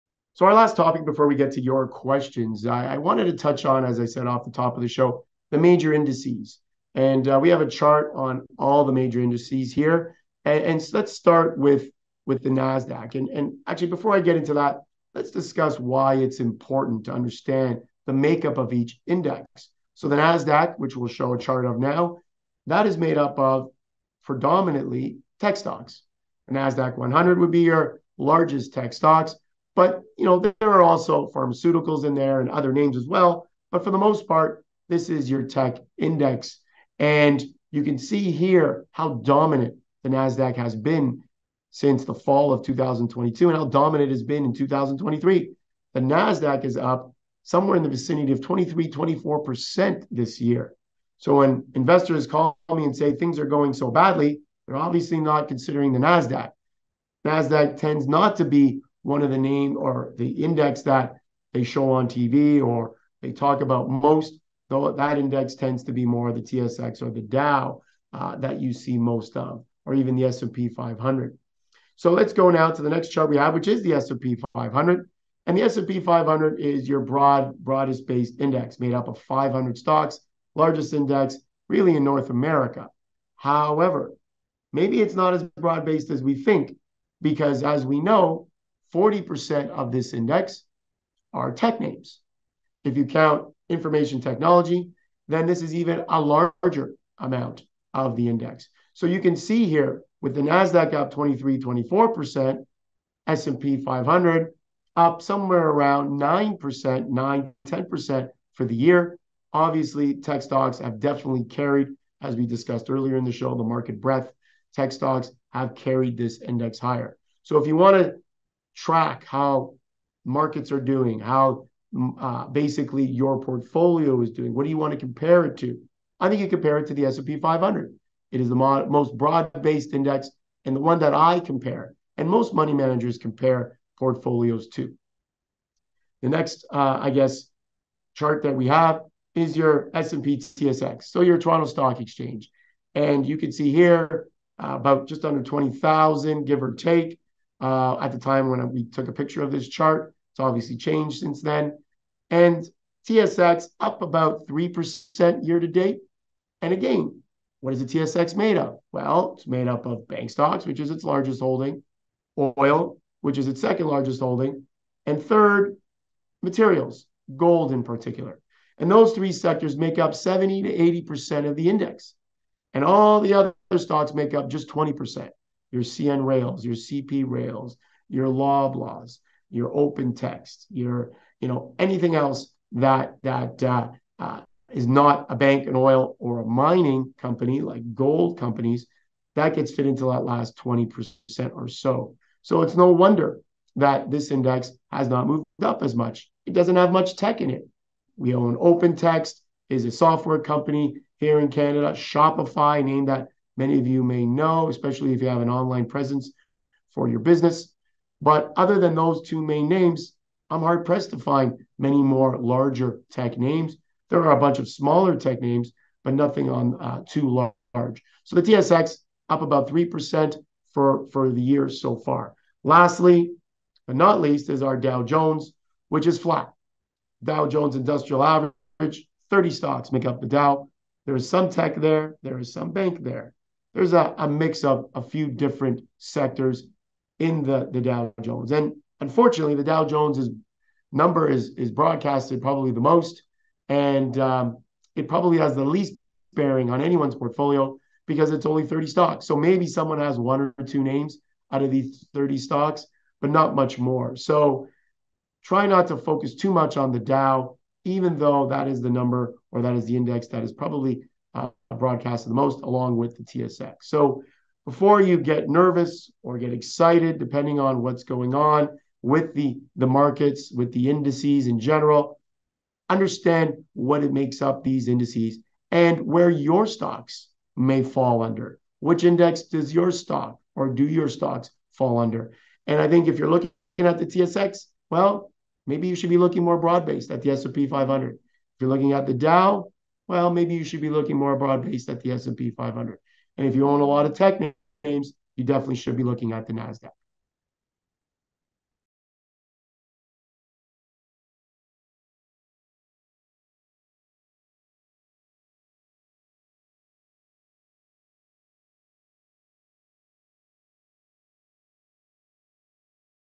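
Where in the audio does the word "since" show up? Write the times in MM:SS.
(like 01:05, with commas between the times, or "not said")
00:41, 02:31.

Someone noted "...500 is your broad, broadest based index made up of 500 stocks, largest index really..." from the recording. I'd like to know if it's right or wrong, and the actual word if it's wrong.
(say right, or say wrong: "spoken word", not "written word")
right.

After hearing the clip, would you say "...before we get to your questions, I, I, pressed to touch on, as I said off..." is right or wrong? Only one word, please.
wrong.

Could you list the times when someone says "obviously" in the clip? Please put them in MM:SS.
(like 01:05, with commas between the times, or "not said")
00:54, 01:49, 02:30.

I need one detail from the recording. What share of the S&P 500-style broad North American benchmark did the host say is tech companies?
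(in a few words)
40%.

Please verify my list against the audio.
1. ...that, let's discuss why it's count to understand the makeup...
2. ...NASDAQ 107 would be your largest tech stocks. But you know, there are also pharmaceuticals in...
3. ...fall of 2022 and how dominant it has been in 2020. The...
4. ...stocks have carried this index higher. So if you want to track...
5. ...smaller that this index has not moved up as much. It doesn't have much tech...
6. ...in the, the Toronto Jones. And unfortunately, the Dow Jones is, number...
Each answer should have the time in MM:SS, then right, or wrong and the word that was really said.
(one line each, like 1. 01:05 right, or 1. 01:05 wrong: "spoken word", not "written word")
1. 00:14 wrong: "important", not "count"
2. 00:26 wrong: "100", not "107"
3. 00:42 wrong: "2023", not "2020"
4. 01:54 right
5. 03:12 wrong: "wonder", not "smaller"
6. 03:57 wrong: "Dow", not "Toronto".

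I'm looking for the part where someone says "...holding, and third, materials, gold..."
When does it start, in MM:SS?
02:44.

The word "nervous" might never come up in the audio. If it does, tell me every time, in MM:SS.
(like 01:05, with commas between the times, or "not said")
04:25.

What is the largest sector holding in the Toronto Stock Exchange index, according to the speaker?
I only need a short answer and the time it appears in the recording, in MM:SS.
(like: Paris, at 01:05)
Bank stocks, at 02:40.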